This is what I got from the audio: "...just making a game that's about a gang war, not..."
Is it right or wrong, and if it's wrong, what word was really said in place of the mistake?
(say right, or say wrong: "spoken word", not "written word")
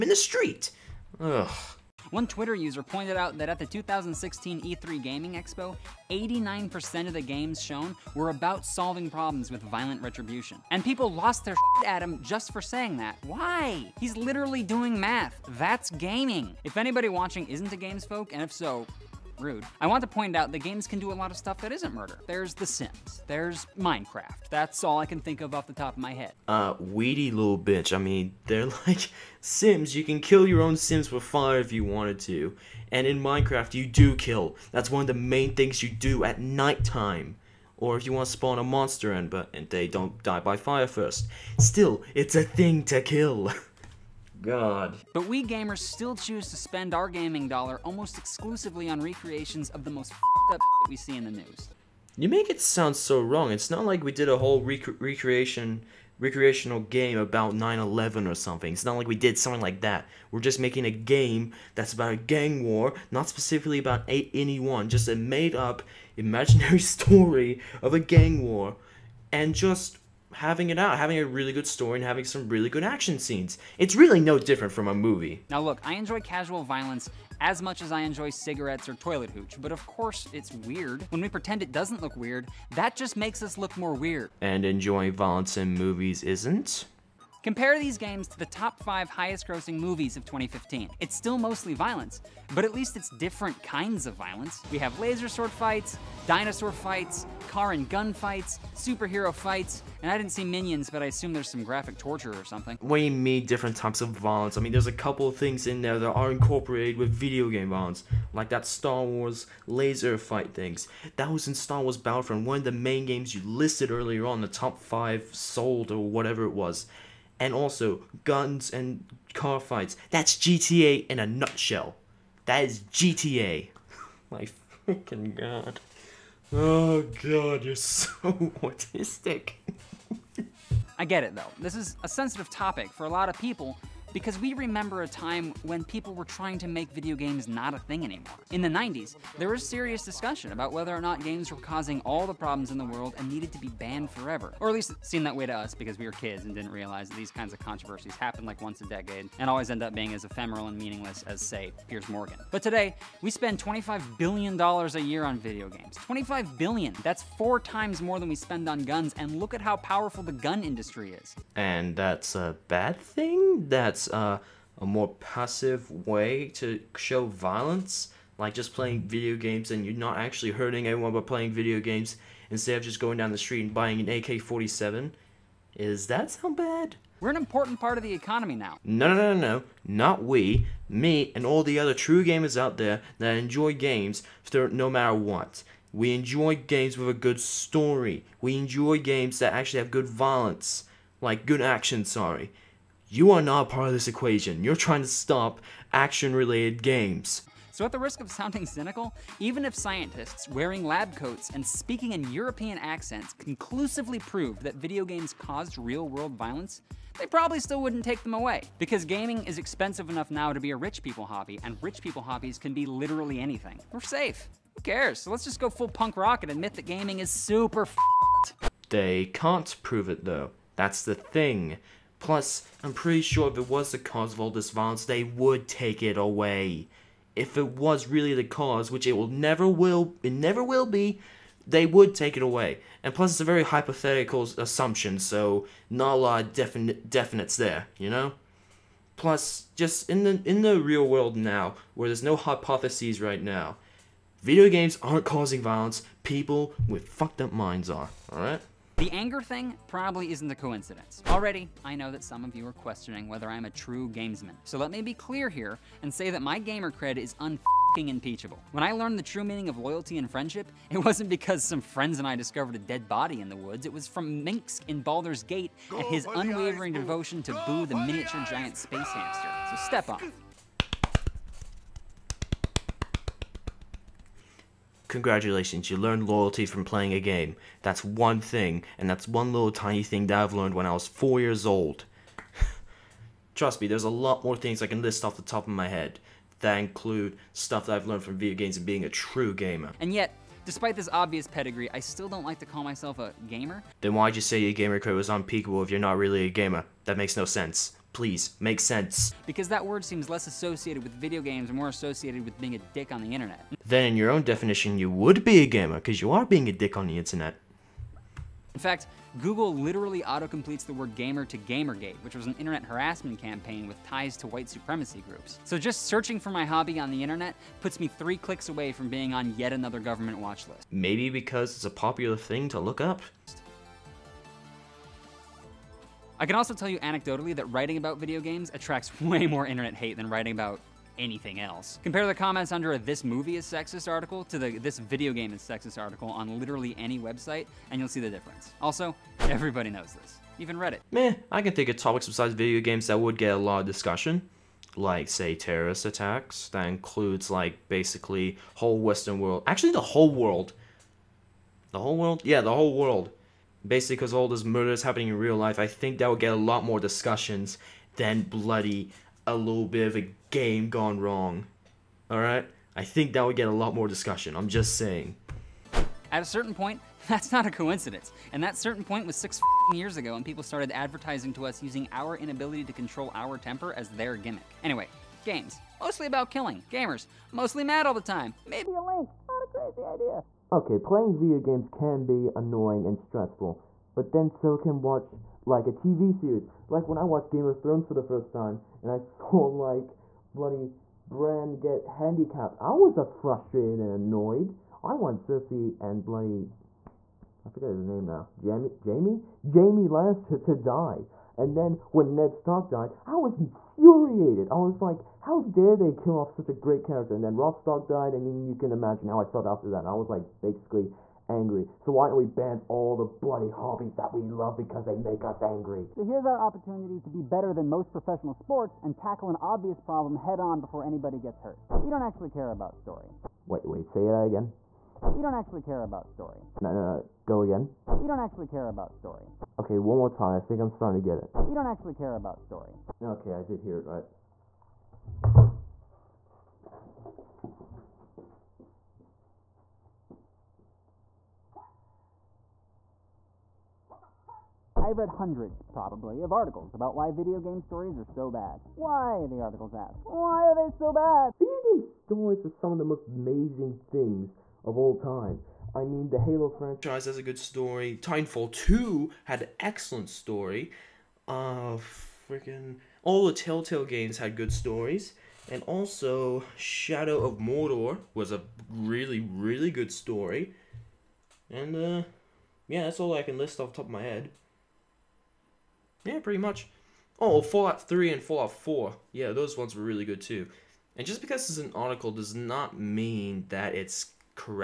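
right.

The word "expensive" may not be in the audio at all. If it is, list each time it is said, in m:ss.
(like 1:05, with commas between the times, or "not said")
3:29.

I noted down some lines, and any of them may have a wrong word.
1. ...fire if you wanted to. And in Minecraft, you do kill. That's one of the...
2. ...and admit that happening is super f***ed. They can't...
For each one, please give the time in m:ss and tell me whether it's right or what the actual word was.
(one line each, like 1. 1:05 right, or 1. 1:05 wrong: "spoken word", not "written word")
1. 0:31 right
2. 3:36 wrong: "gaming", not "happening".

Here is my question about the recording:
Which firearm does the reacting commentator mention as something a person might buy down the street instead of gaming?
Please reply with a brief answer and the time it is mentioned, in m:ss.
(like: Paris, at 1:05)
AK 47, at 2:54.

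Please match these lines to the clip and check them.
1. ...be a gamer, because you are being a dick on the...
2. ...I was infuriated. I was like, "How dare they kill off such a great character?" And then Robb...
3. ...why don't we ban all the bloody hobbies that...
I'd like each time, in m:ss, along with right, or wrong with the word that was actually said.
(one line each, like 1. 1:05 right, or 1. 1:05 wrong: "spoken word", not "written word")
1. 5:05 right
2. 6:43 right
3. 6:52 right.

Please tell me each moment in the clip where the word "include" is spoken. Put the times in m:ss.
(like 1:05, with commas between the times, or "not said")
4:46, 5:46.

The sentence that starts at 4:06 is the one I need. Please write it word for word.
People with fucked up minds are.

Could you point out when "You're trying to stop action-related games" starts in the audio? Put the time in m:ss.
3:14.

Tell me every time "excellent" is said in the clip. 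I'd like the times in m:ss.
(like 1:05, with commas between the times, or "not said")
7:39.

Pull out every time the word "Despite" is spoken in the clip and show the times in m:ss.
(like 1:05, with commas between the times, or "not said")
4:50.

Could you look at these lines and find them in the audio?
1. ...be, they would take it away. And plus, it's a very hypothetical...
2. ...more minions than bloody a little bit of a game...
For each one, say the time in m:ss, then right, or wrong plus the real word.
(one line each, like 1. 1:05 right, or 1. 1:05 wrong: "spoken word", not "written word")
1. 3:50 right
2. 5:56 wrong: "discussions", not "minions".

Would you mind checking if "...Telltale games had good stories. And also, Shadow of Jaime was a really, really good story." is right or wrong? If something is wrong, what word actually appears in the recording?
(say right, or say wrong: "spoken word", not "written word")
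wrong: "Mordor", not "Jaime".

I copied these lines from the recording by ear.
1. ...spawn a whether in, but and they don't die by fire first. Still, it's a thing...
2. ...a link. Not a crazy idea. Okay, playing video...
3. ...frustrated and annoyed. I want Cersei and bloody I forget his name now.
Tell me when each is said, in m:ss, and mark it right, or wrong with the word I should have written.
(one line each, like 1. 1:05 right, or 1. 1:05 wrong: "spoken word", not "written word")
1. 0:38 wrong: "monster", not "whether"
2. 6:18 right
3. 6:33 right.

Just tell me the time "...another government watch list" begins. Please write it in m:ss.
5:19.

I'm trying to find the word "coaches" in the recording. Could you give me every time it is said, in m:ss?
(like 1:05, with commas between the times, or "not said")
not said.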